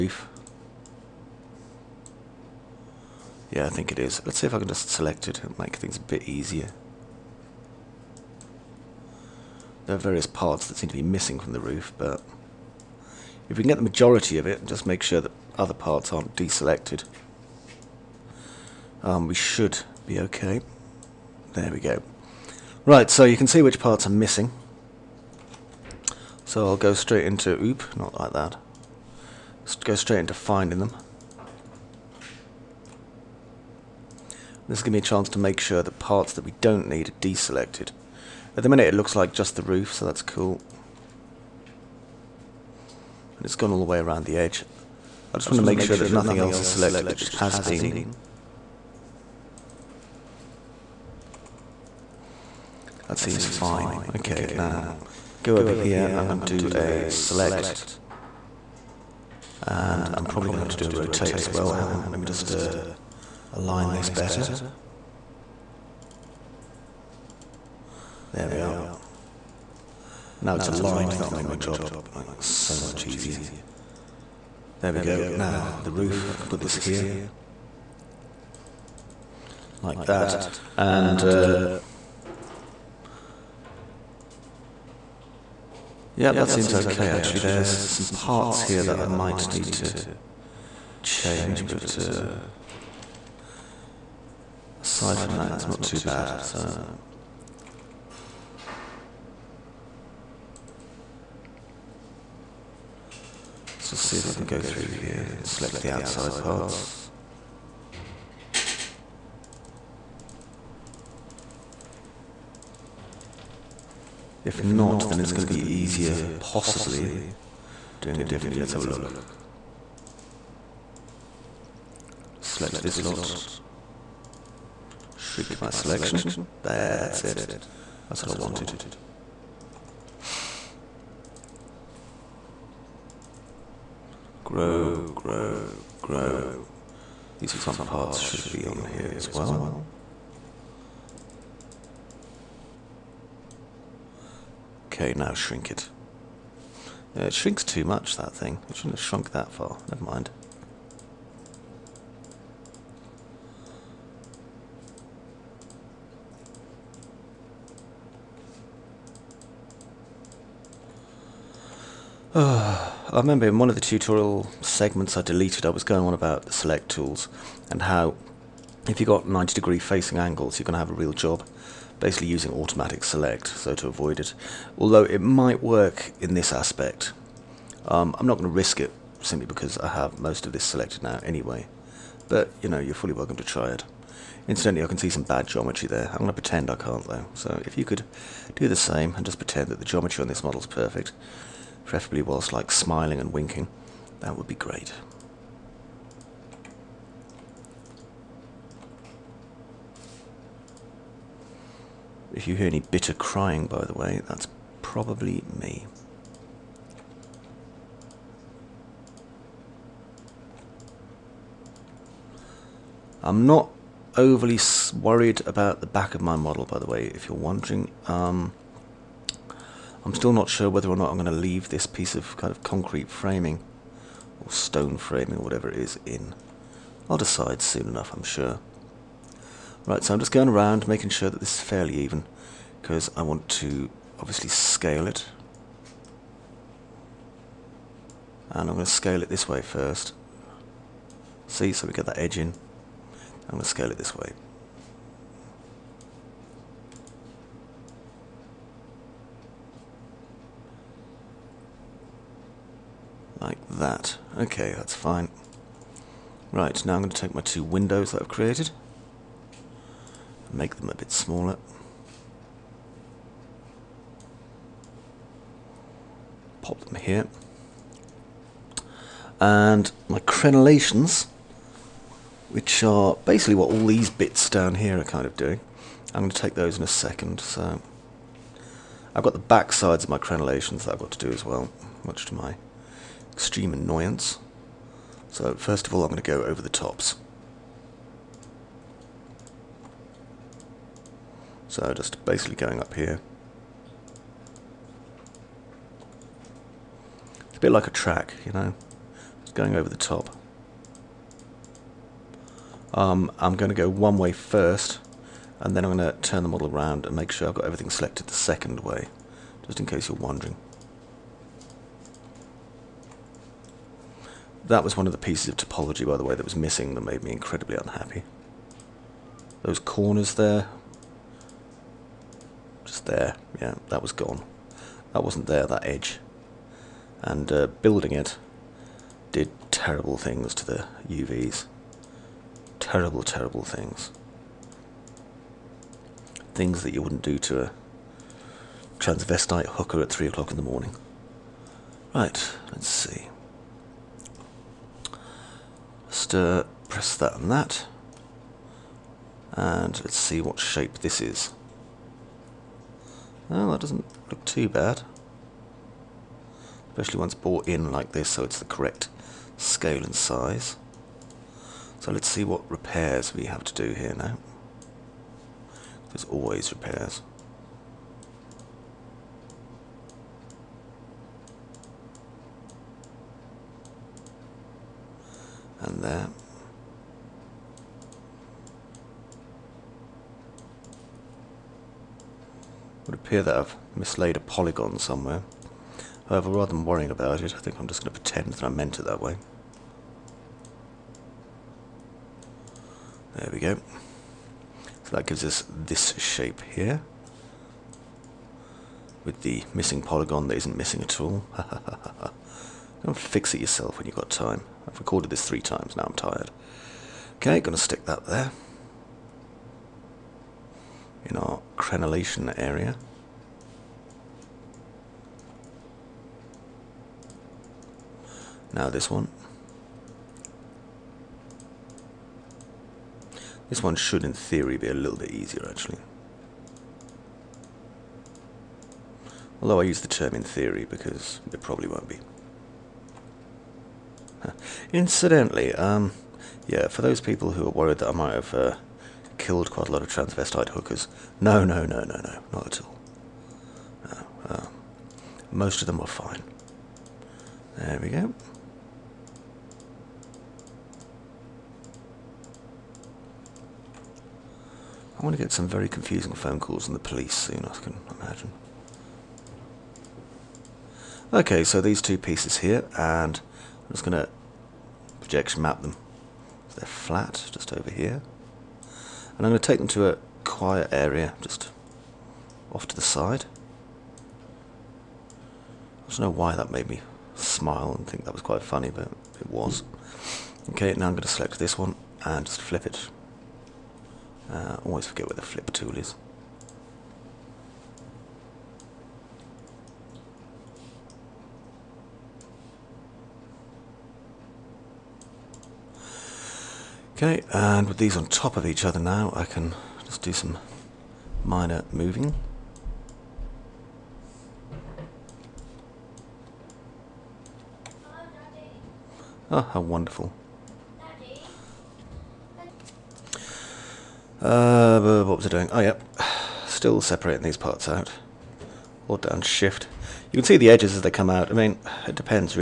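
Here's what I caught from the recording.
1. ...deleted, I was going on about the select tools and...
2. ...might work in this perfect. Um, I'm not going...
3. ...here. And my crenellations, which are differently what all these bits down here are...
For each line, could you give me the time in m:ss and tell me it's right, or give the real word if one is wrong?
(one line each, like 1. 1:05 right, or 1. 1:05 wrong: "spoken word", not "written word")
1. 2:45 right
2. 2:55 wrong: "aspect", not "perfect"
3. 4:26 wrong: "basically", not "differently".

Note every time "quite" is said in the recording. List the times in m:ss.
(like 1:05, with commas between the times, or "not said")
7:19, 7:58.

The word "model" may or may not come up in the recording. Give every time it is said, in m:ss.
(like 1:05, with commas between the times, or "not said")
3:10, 3:36, 5:06.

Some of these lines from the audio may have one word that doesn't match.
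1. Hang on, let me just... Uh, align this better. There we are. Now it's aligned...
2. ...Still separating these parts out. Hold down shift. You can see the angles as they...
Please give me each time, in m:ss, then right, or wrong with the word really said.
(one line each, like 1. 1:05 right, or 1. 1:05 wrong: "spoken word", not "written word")
1. 1:01 right
2. 8:36 wrong: "edges", not "angles".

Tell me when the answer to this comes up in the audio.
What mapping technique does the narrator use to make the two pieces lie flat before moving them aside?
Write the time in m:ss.
7:45.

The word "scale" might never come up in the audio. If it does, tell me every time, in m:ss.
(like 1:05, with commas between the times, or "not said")
3:54, 3:58, 4:03, 5:59.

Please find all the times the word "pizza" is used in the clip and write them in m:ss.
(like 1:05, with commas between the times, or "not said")
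not said.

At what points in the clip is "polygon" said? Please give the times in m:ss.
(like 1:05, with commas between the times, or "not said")
6:24, 6:40.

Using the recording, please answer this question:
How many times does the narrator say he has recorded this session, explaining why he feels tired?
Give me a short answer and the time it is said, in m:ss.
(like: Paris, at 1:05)
3, at 6:45.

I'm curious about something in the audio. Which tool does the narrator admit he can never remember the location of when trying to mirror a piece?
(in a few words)
flip tool.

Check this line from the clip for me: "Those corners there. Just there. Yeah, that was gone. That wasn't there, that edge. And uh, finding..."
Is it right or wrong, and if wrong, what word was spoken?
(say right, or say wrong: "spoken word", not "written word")
wrong: "building", not "finding".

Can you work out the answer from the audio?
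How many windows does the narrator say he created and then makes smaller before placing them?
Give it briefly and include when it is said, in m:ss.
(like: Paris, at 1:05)
2, at 4:17.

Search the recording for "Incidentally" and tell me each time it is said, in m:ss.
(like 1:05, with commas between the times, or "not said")
3:04, 7:14.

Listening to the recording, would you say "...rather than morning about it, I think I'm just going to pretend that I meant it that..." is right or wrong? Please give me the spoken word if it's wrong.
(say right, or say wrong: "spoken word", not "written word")
wrong: "worrying", not "morning".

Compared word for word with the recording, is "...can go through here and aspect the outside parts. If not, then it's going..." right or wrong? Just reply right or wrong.
wrong.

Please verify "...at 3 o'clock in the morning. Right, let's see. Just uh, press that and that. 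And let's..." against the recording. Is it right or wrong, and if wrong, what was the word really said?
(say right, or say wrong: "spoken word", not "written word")
right.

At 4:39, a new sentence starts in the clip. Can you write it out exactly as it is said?
I've got the back sides of my crenellations that I've got to do as well, much to my extreme annoyance.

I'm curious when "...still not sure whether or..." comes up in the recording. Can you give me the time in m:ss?
3:40.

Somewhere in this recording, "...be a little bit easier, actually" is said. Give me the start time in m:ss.
7:04.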